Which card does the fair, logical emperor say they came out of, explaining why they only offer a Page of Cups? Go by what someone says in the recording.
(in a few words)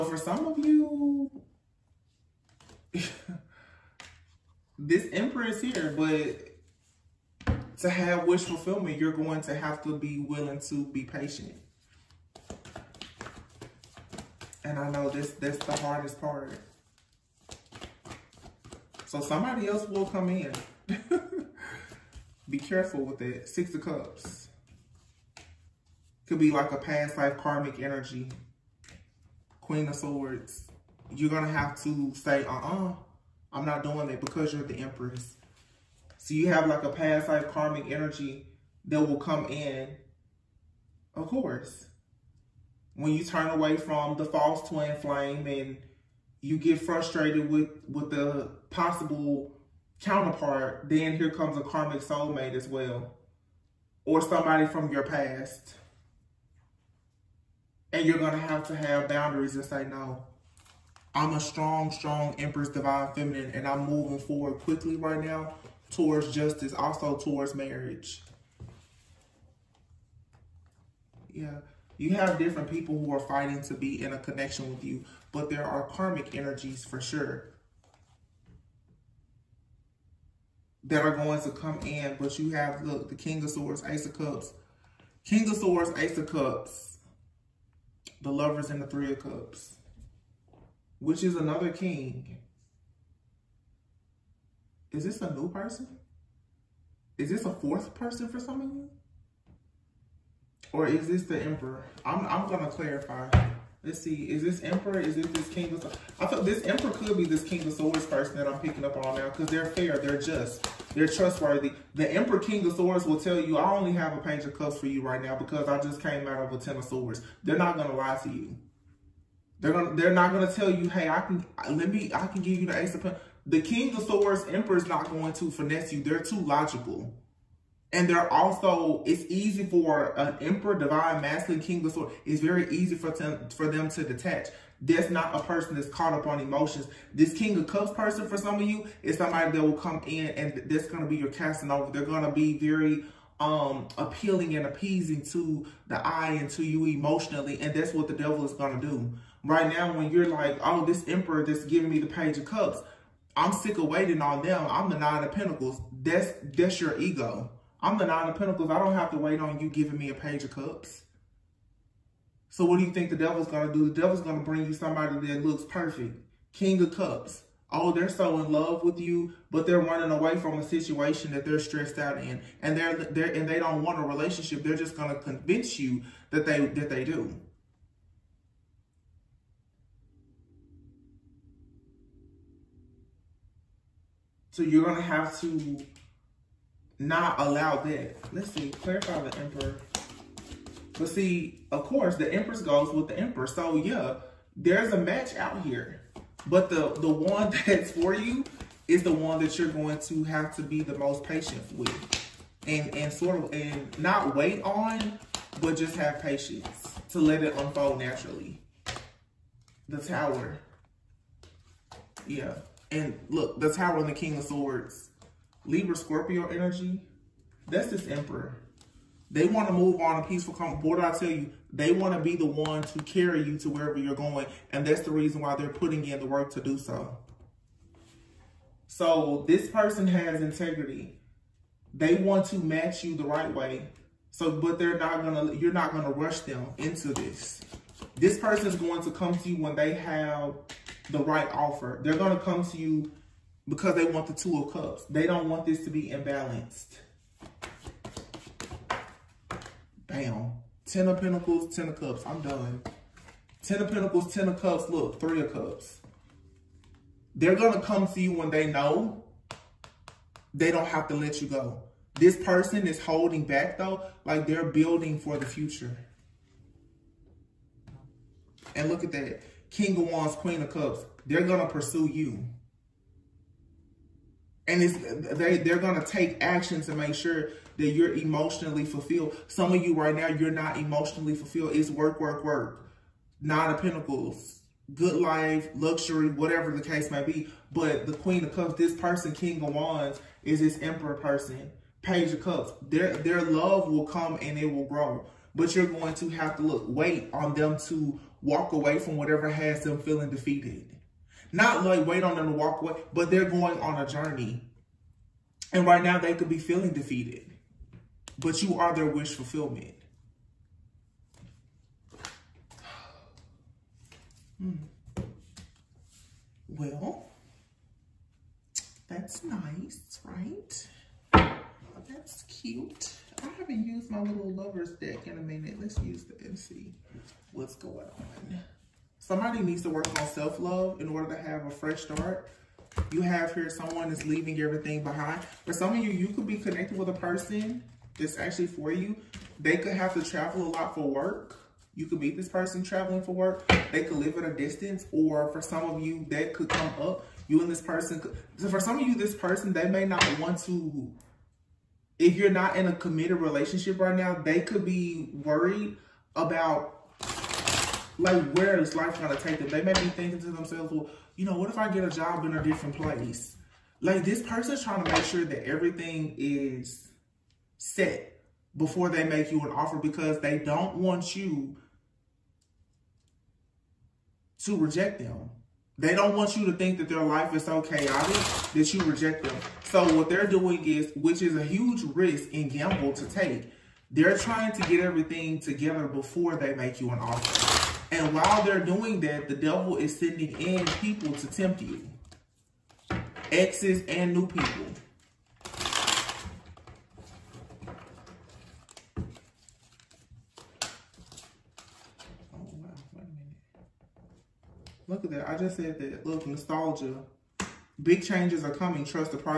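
Ten of Swords.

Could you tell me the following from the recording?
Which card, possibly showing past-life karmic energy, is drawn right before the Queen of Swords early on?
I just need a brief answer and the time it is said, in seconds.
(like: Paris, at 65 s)
Six of Cups, at 23 s.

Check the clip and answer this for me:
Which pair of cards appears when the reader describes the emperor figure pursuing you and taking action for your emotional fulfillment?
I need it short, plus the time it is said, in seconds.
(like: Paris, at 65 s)
King of Wands, Queen of Cups, at 269 s.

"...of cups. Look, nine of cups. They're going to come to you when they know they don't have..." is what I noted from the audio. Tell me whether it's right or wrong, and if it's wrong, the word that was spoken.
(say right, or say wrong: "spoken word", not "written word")
wrong: "three", not "nine".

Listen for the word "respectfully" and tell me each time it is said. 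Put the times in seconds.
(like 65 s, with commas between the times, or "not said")
not said.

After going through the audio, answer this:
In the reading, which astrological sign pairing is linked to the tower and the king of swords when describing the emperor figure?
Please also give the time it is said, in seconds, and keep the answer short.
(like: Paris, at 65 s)
Libra Scorpio, at 215 s.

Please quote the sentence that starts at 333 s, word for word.
You have here someone is leaving everything behind.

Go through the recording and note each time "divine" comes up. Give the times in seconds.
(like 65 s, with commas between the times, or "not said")
62 s, 130 s.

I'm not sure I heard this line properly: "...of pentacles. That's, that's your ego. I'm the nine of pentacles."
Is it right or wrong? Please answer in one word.
right.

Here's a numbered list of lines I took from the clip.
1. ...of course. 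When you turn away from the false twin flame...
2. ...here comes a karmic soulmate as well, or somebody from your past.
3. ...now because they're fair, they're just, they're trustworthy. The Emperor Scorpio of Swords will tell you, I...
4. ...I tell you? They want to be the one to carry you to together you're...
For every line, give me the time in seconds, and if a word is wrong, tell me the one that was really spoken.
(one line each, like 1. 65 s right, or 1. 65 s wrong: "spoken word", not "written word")
1. 41 s right
2. 51 s right
3. 109 s wrong: "King", not "Scorpio"
4. 220 s wrong: "wherever", not "together".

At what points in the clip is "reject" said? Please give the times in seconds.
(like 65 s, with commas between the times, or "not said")
374 s, 379 s.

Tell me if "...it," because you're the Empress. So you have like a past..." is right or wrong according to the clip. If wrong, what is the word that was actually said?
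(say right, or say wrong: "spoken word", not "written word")
right.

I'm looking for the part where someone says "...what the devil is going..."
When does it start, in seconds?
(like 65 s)
147 s.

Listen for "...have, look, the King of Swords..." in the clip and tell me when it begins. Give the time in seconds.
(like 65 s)
82 s.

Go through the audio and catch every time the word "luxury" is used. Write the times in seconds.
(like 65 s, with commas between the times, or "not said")
285 s.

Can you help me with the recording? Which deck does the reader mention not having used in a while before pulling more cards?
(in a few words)
lover's deck.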